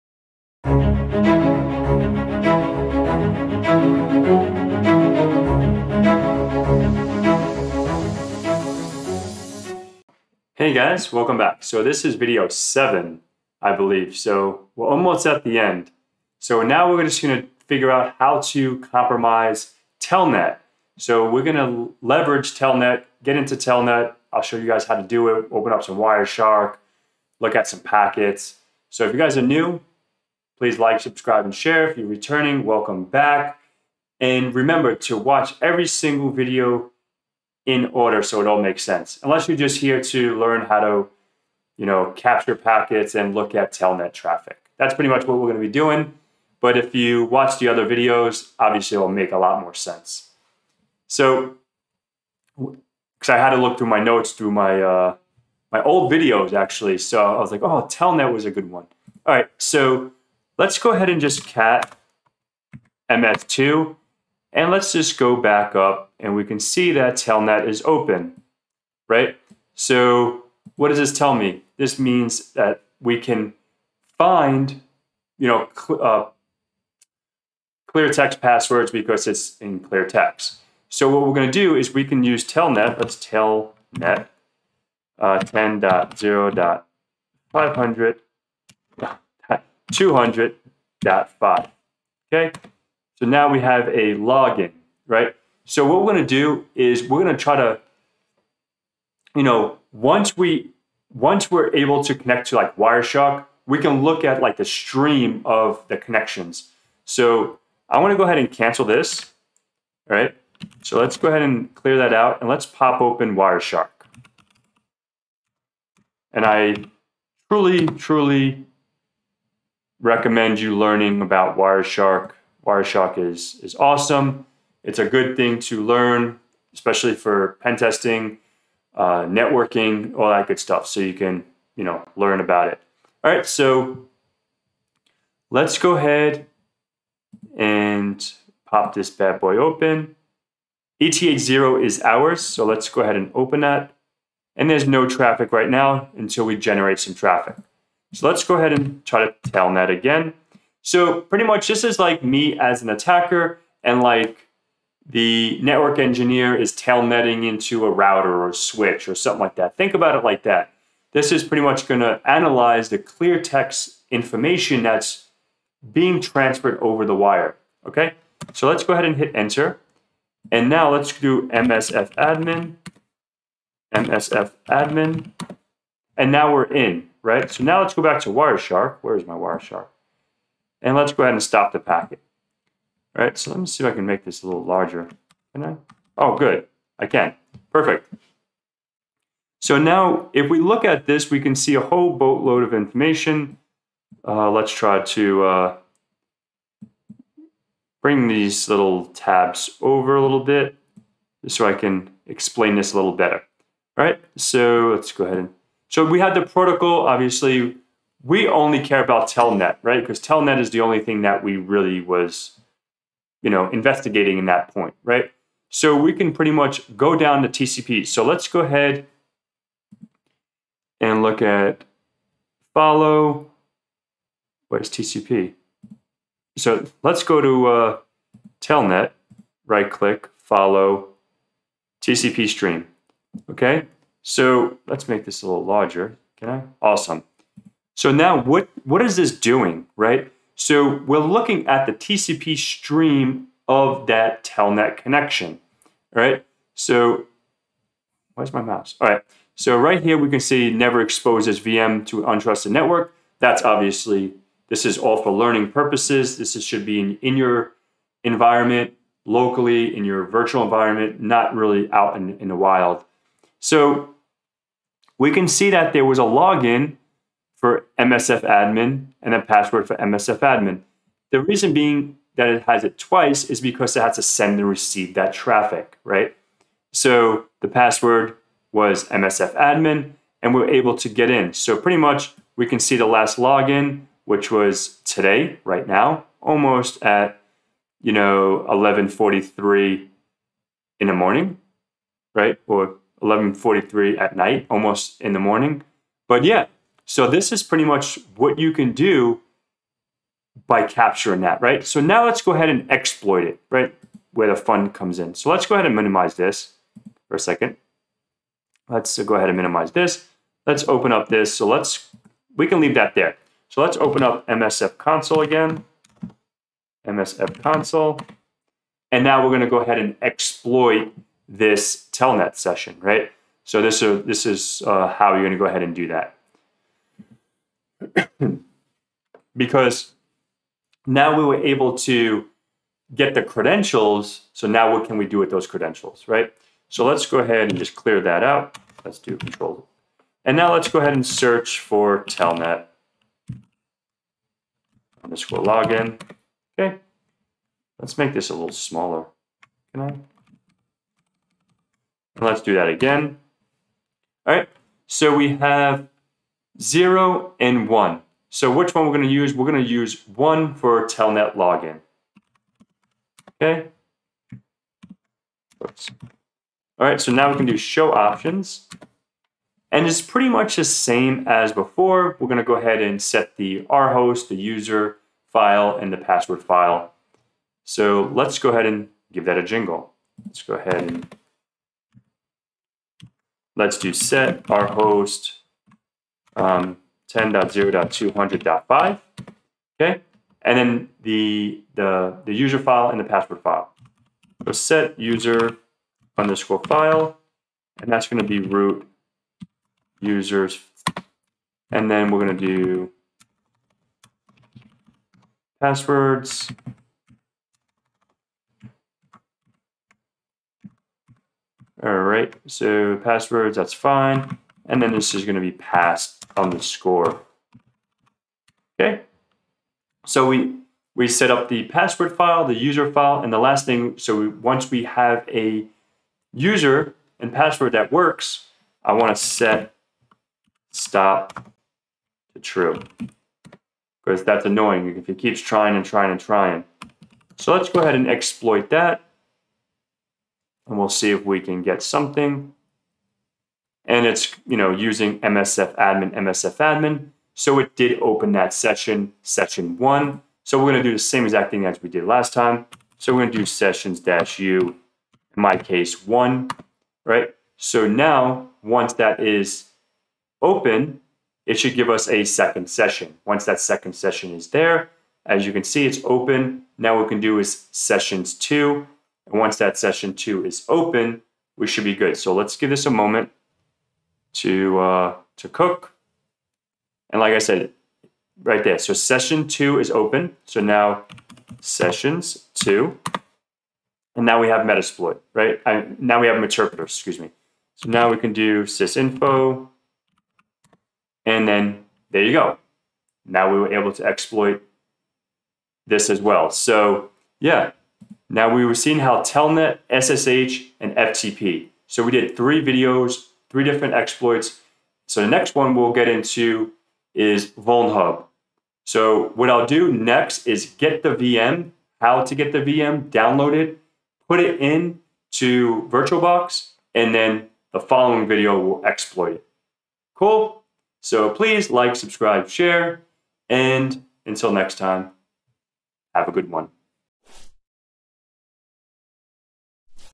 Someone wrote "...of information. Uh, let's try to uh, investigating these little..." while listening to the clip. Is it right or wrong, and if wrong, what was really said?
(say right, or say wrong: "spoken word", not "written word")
wrong: "bring", not "investigating".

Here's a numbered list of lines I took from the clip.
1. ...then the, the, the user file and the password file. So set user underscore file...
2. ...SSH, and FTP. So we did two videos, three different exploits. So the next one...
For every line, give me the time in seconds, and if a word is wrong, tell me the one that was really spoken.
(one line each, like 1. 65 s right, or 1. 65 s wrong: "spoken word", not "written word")
1. 390 s right
2. 500 s wrong: "three", not "two".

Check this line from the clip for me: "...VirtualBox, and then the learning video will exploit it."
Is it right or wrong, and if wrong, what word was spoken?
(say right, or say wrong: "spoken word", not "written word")
wrong: "following", not "learning".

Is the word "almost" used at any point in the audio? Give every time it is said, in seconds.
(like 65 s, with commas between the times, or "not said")
14 s, 286 s, 294 s.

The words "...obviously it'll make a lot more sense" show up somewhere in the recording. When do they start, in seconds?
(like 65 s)
48 s.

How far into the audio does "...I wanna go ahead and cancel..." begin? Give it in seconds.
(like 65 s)
107 s.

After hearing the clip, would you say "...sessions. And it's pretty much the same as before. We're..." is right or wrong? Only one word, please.
wrong.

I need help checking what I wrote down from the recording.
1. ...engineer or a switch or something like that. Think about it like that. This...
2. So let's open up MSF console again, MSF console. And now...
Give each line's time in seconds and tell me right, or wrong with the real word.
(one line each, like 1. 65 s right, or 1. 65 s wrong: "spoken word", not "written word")
1. 157 s wrong: "router", not "engineer"
2. 313 s right.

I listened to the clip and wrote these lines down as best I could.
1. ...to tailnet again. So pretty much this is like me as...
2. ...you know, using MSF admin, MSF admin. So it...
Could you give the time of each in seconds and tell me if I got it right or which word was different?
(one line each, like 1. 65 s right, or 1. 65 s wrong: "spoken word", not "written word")
1. 149 s right
2. 444 s right.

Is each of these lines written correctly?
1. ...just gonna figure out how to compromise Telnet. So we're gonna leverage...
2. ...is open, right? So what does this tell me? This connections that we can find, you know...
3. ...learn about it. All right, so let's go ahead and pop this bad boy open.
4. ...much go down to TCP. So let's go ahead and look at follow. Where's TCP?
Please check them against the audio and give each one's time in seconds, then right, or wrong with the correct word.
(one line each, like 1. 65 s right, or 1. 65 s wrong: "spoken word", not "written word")
1. 17 s right
2. 67 s wrong: "means", not "connections"
3. 132 s right
4. 216 s right.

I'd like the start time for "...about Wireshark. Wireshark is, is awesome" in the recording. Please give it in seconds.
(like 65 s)
121 s.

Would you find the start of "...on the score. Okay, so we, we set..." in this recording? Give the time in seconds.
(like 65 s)
416 s.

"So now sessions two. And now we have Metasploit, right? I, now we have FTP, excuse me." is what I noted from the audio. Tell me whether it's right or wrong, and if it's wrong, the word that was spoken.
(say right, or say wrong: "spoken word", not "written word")
wrong: "Meterpreter", not "FTP".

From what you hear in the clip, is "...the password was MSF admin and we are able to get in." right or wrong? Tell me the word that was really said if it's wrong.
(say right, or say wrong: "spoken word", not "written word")
right.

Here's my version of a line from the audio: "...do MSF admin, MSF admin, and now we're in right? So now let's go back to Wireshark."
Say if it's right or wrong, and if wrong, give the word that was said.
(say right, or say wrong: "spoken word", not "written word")
right.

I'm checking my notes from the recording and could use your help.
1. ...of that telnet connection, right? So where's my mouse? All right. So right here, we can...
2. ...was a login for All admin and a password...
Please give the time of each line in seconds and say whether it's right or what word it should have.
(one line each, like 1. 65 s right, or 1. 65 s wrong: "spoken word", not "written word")
1. 243 s right
2. 266 s wrong: "MSF", not "All".